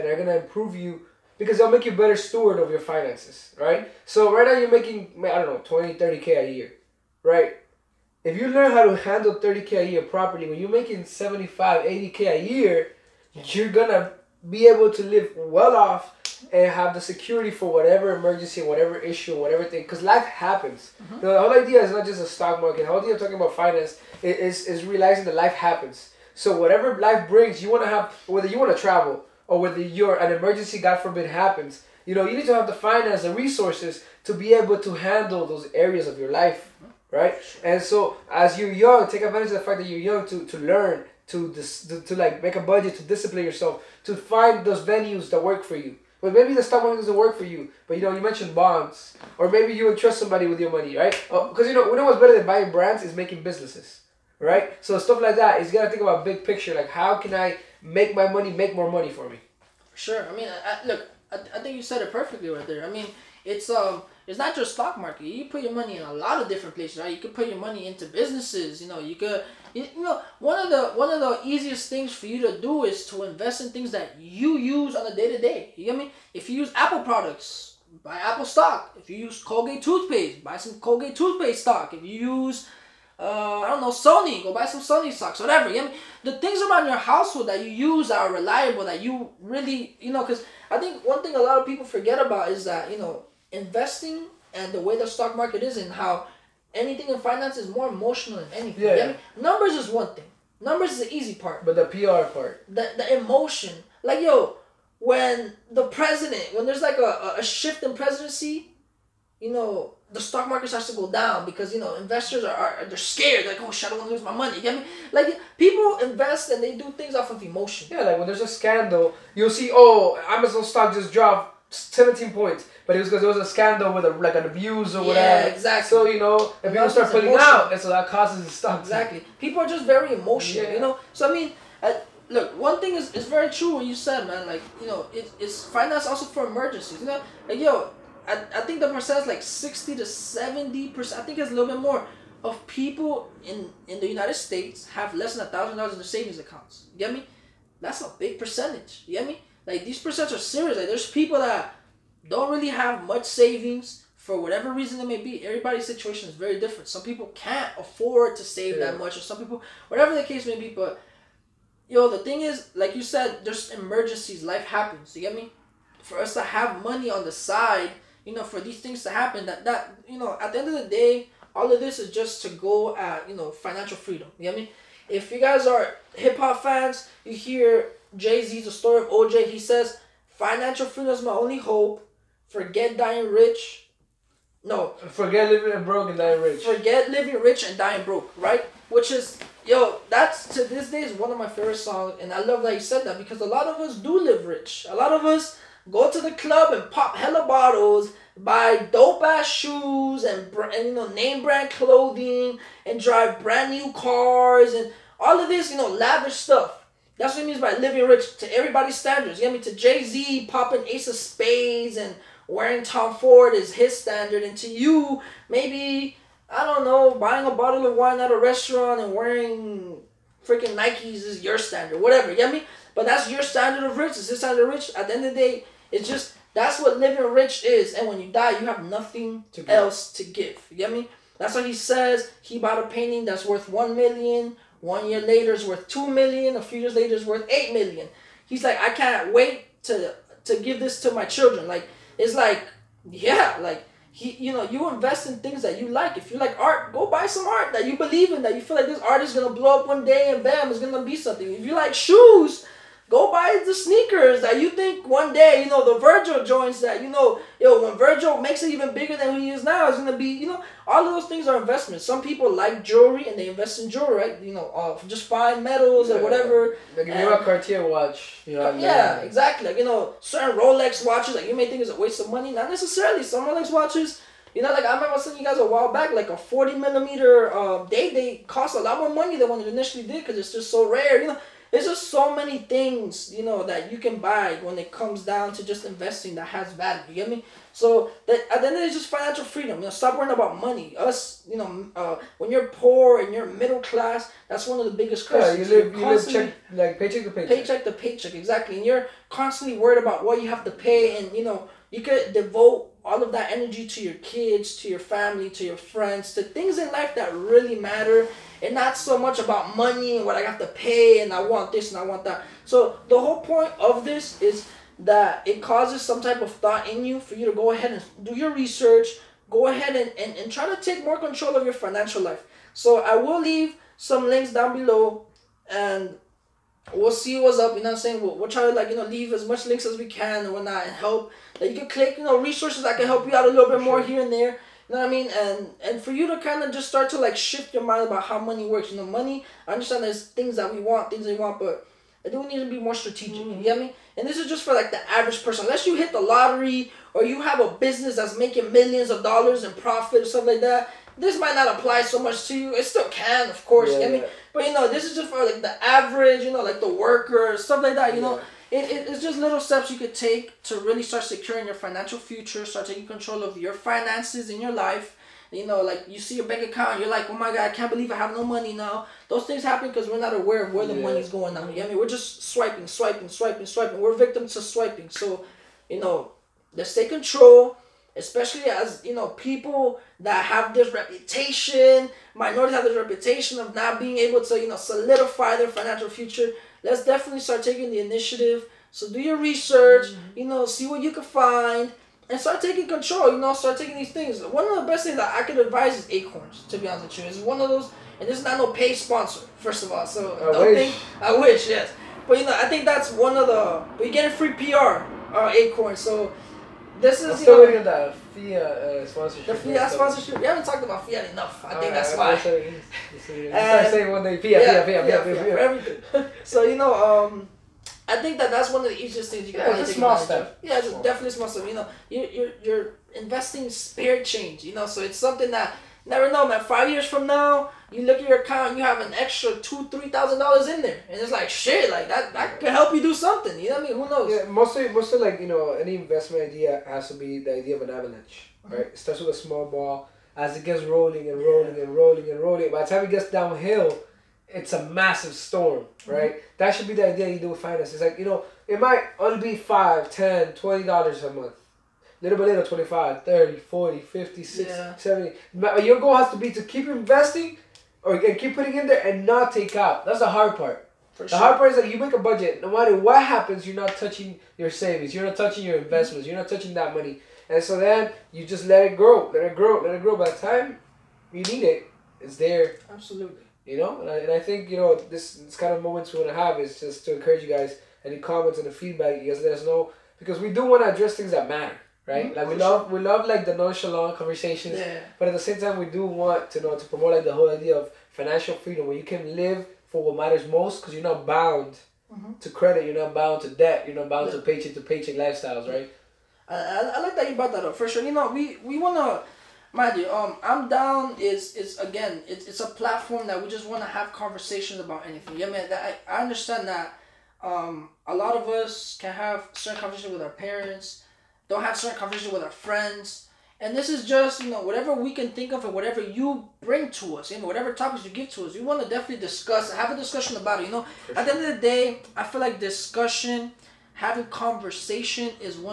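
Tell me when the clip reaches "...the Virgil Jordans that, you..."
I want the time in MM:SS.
04:15.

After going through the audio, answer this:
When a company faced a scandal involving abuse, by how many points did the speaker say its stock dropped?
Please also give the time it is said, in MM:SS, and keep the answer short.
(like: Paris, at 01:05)
17, at 02:01.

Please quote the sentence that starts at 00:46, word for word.
But maybe the stock market doesn't work for you.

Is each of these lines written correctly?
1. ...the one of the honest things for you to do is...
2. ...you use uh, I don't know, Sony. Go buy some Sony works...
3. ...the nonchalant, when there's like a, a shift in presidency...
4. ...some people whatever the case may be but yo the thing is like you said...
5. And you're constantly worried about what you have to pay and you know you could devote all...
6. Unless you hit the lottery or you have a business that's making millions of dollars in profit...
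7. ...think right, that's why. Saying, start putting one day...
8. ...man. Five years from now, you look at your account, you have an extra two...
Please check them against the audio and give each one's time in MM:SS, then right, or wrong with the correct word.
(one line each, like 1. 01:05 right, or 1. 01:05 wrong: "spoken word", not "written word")
1. 01:10 wrong: "easiest", not "honest"
2. 01:22 wrong: "socks", not "works"
3. 01:45 wrong: "president", not "nonchalant"
4. 02:39 right
5. 04:58 right
6. 05:45 right
7. 06:51 wrong: "saying", not "putting"
8. 07:06 right.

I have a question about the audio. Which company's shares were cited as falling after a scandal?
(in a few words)
Amazon.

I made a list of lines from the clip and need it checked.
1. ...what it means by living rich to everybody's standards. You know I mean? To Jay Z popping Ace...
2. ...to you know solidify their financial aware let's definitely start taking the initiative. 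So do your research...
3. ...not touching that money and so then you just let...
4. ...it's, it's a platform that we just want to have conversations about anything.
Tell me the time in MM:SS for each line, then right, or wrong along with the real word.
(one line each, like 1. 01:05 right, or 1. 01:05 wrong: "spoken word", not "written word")
1. 03:27 right
2. 06:24 wrong: "future", not "aware"
3. 07:46 right
4. 08:22 right.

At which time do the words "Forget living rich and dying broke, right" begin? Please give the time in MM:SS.
03:06.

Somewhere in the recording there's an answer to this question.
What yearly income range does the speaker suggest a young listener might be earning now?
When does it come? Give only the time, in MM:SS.
00:05.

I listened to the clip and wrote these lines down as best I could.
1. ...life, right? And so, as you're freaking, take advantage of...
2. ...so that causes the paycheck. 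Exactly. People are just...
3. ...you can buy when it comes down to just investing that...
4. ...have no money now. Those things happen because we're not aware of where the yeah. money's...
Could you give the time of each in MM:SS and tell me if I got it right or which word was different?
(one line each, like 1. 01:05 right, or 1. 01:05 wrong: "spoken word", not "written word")
1. 00:36 wrong: "young", not "freaking"
2. 02:07 wrong: "stock", not "paycheck"
3. 04:43 right
4. 06:08 right.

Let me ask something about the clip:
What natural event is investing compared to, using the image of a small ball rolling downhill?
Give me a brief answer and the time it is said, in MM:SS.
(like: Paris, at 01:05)
an avalanche, at 07:17.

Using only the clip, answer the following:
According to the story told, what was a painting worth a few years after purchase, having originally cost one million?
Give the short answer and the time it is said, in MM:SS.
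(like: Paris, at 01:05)
8 million, at 03:57.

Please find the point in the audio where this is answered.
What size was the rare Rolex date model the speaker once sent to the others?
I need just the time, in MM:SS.
04:36.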